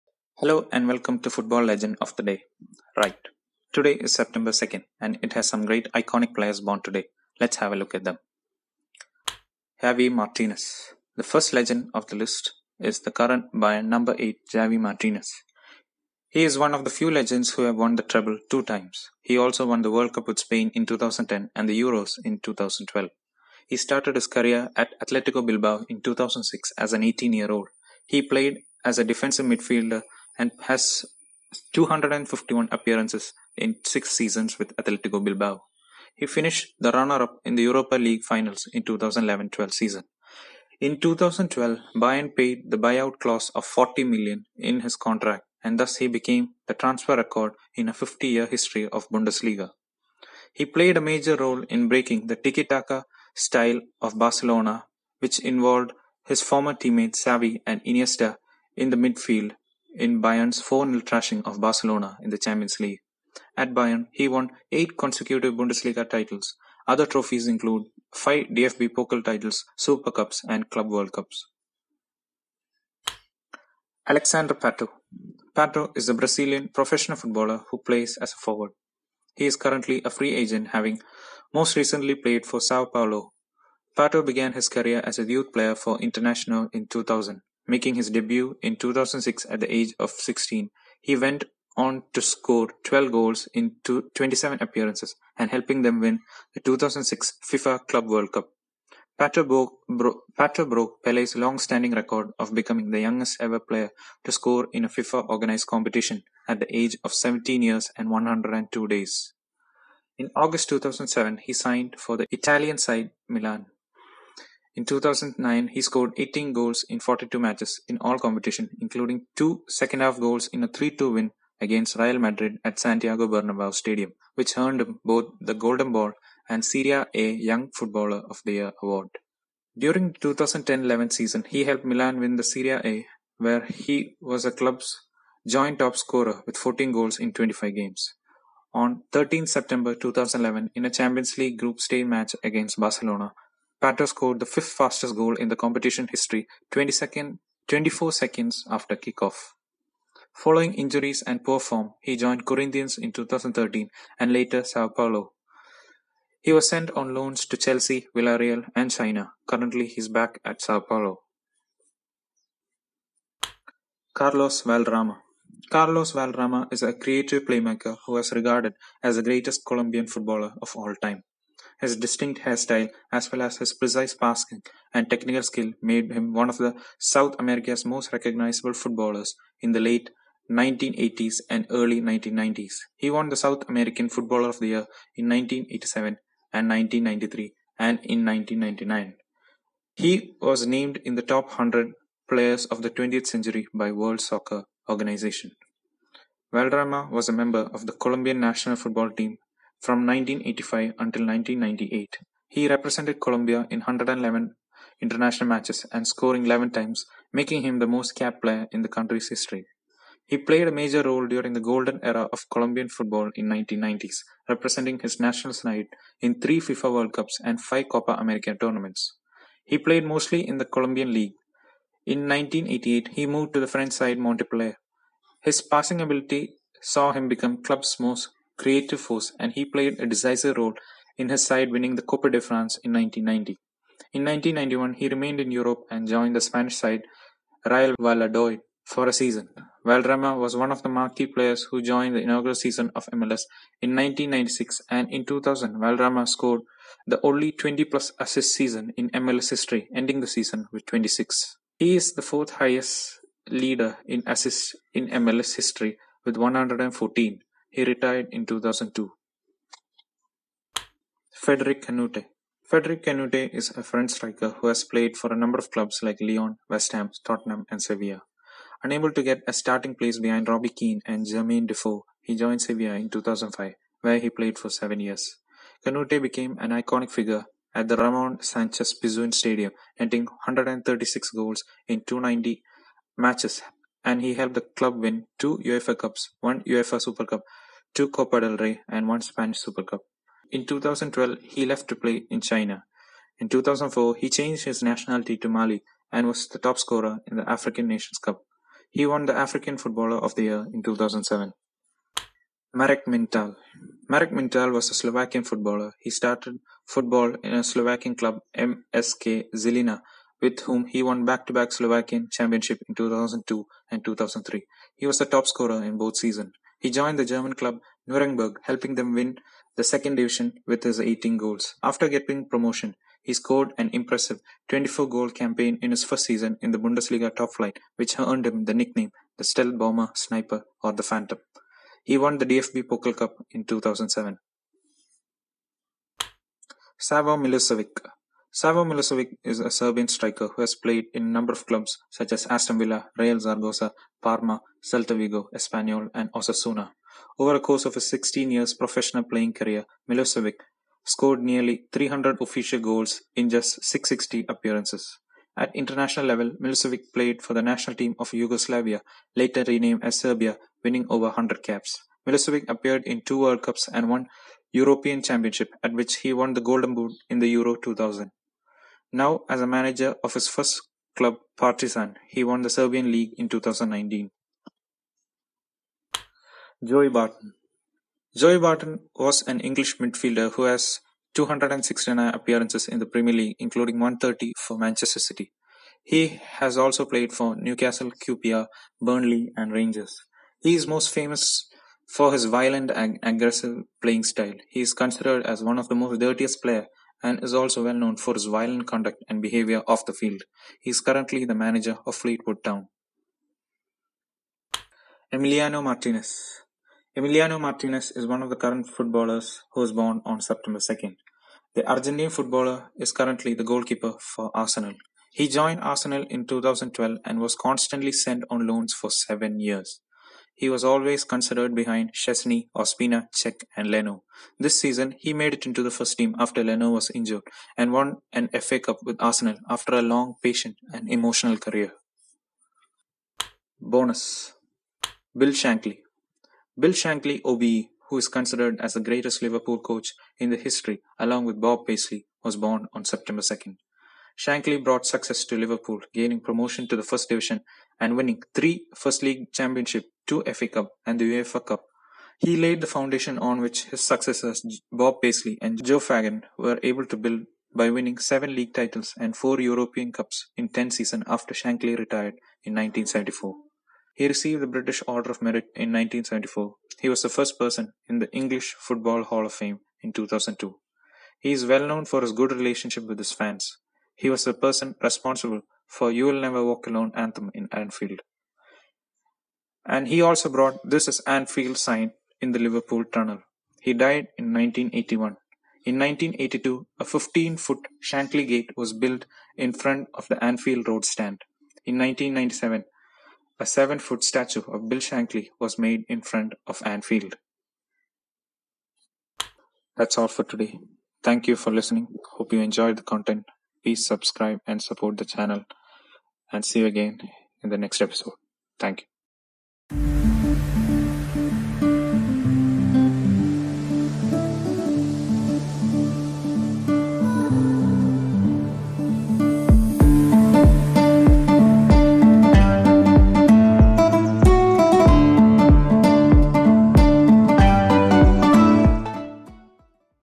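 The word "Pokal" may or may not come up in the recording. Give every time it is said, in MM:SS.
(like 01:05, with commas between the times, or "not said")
01:08, 05:32.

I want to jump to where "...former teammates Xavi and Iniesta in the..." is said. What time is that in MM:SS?
00:56.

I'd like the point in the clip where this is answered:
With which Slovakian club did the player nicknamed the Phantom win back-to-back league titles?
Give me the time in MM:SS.
05:08.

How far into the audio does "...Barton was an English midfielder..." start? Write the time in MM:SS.
06:18.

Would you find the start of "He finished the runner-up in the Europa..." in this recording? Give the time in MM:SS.
00:36.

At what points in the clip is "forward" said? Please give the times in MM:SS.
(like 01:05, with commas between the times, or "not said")
01:18.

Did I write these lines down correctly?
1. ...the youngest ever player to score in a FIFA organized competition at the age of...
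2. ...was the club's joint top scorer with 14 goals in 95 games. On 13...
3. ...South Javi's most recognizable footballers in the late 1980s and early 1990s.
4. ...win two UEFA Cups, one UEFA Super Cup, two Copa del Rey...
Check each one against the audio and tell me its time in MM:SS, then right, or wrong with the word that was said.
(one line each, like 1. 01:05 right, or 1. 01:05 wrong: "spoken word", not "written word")
1. 01:42 right
2. 02:14 wrong: "25", not "95"
3. 02:56 wrong: "America", not "Javi"
4. 04:44 right.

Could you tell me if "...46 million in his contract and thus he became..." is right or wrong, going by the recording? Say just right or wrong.
wrong.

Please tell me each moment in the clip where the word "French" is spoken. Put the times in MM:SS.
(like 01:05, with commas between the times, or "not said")
03:43, 04:23.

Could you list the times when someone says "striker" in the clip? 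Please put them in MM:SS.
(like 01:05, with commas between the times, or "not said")
04:24, 05:40.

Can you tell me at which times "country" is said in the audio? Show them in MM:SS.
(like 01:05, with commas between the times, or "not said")
03:28.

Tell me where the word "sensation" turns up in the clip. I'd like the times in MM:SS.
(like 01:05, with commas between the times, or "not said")
not said.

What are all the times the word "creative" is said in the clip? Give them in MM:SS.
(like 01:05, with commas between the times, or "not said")
02:46, 03:48.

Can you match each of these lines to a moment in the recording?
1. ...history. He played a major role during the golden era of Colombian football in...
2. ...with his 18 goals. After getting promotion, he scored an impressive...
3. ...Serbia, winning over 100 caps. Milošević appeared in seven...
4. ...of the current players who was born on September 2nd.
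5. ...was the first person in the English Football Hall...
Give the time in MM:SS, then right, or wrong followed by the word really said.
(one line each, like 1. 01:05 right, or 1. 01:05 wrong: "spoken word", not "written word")
1. 03:29 right
2. 05:20 right
3. 06:00 wrong: "two", not "seven"
4. 06:48 wrong: "footballers", not "players"
5. 07:47 right.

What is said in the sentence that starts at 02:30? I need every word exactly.
Following injuries and poor form, he joined Corinthians in 2013 and later Sao Paulo.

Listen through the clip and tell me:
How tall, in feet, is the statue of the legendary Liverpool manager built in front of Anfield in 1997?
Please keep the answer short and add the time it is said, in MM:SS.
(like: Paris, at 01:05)
7 feet, at 08:13.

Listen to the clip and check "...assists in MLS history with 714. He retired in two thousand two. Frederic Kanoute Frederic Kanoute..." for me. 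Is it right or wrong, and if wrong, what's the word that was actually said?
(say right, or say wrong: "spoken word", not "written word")
wrong: "114", not "714".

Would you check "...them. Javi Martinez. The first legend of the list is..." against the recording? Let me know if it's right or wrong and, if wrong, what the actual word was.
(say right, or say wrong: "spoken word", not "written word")
right.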